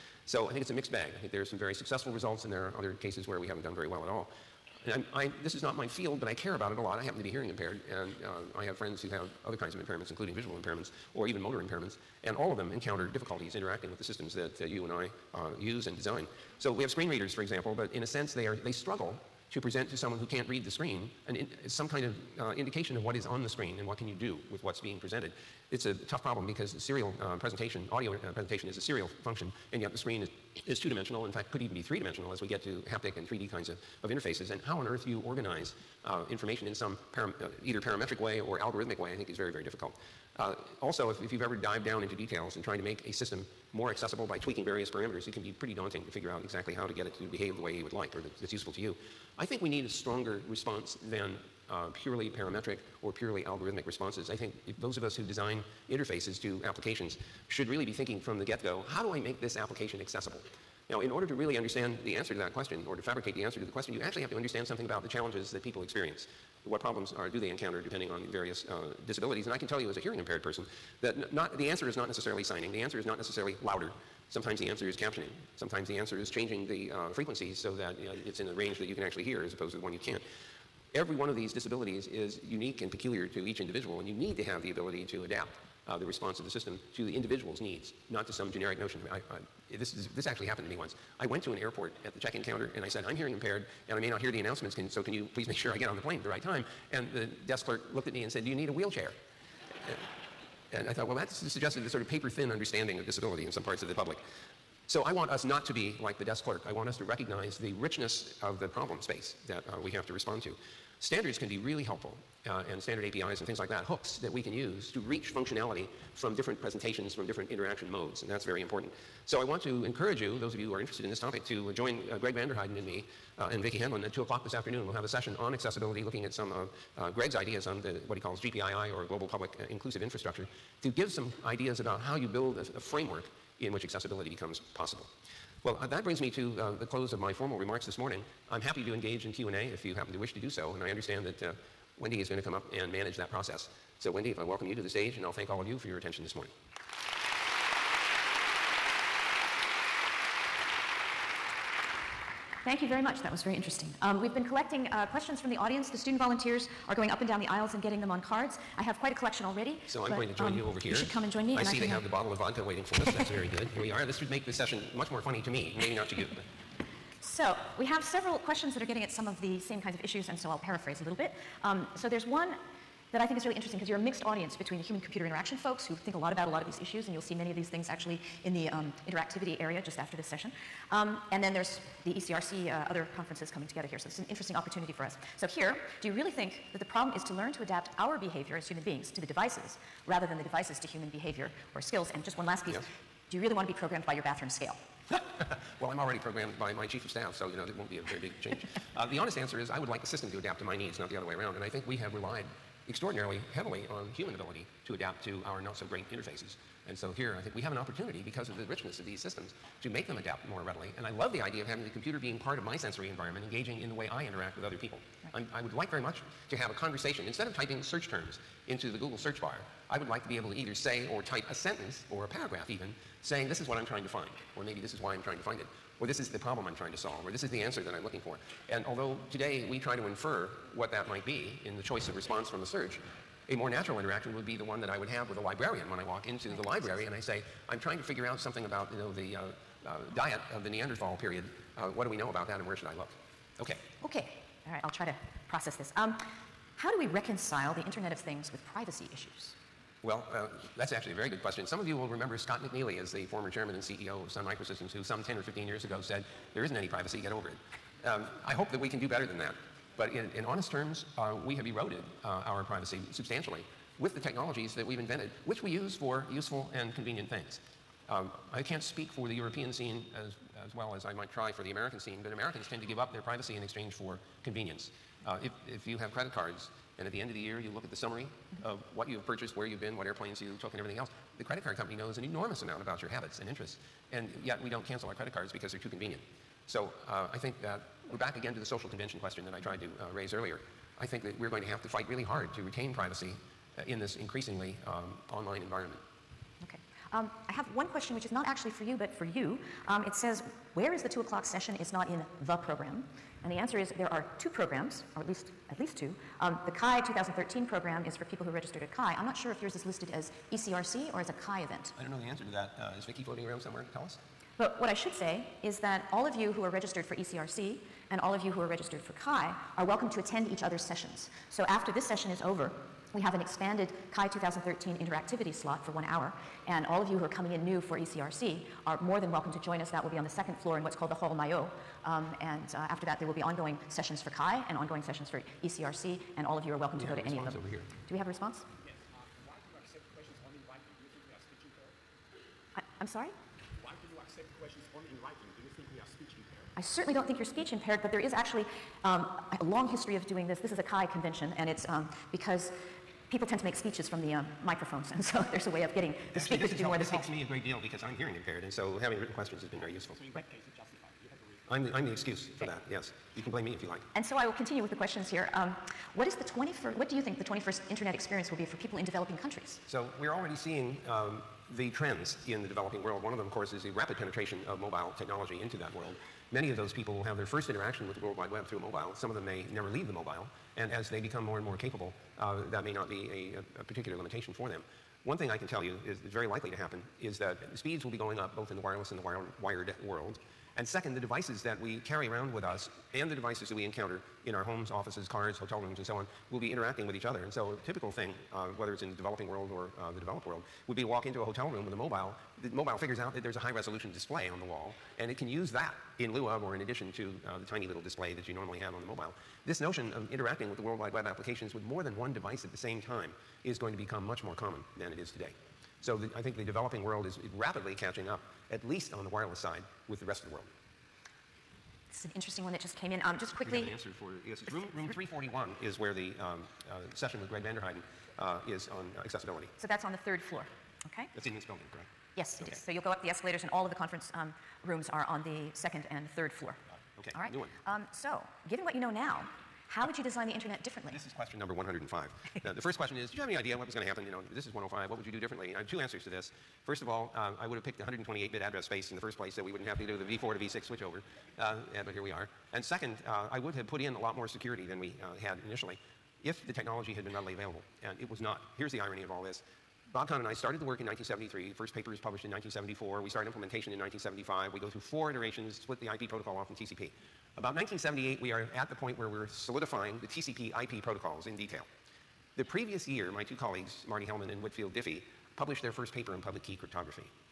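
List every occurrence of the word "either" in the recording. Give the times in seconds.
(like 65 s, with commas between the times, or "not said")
37 s, 220 s.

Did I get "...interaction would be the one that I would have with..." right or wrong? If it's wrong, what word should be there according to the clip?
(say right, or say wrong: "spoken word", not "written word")
right.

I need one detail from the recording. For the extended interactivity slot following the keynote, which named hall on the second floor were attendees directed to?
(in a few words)
Hall Maillot.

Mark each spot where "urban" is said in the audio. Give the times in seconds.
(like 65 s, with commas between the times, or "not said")
not said.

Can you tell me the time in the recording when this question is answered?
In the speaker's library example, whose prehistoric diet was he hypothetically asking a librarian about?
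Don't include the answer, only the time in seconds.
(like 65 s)
240 s.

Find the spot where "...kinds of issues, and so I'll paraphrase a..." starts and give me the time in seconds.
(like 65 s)
169 s.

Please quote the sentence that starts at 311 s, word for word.
I don't know the answer to that.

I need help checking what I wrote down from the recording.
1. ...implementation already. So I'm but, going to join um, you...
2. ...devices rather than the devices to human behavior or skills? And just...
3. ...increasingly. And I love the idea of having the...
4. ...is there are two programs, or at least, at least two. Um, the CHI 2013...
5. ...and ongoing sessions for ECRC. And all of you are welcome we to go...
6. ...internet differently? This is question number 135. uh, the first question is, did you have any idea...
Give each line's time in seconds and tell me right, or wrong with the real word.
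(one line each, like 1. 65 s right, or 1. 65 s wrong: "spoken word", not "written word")
1. 159 s wrong: "collection", not "implementation"
2. 189 s right
3. 210 s wrong: "readily", not "increasingly"
4. 303 s right
5. 334 s right
6. 440 s wrong: "105", not "135".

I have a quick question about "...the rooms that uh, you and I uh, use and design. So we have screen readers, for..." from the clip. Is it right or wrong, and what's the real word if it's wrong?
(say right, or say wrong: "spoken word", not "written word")
wrong: "systems", not "rooms".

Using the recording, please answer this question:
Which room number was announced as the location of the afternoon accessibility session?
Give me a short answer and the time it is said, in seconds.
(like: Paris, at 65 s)
341, at 425 s.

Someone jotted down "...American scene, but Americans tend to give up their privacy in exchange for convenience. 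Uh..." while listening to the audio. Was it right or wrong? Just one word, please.
right.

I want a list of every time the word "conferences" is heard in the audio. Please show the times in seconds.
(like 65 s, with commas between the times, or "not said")
183 s, 433 s.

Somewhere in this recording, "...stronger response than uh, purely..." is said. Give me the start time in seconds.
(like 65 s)
49 s.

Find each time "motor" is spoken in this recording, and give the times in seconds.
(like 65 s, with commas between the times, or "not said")
11 s.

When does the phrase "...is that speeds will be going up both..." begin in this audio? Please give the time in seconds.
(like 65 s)
387 s.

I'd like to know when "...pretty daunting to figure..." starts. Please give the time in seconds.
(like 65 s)
45 s.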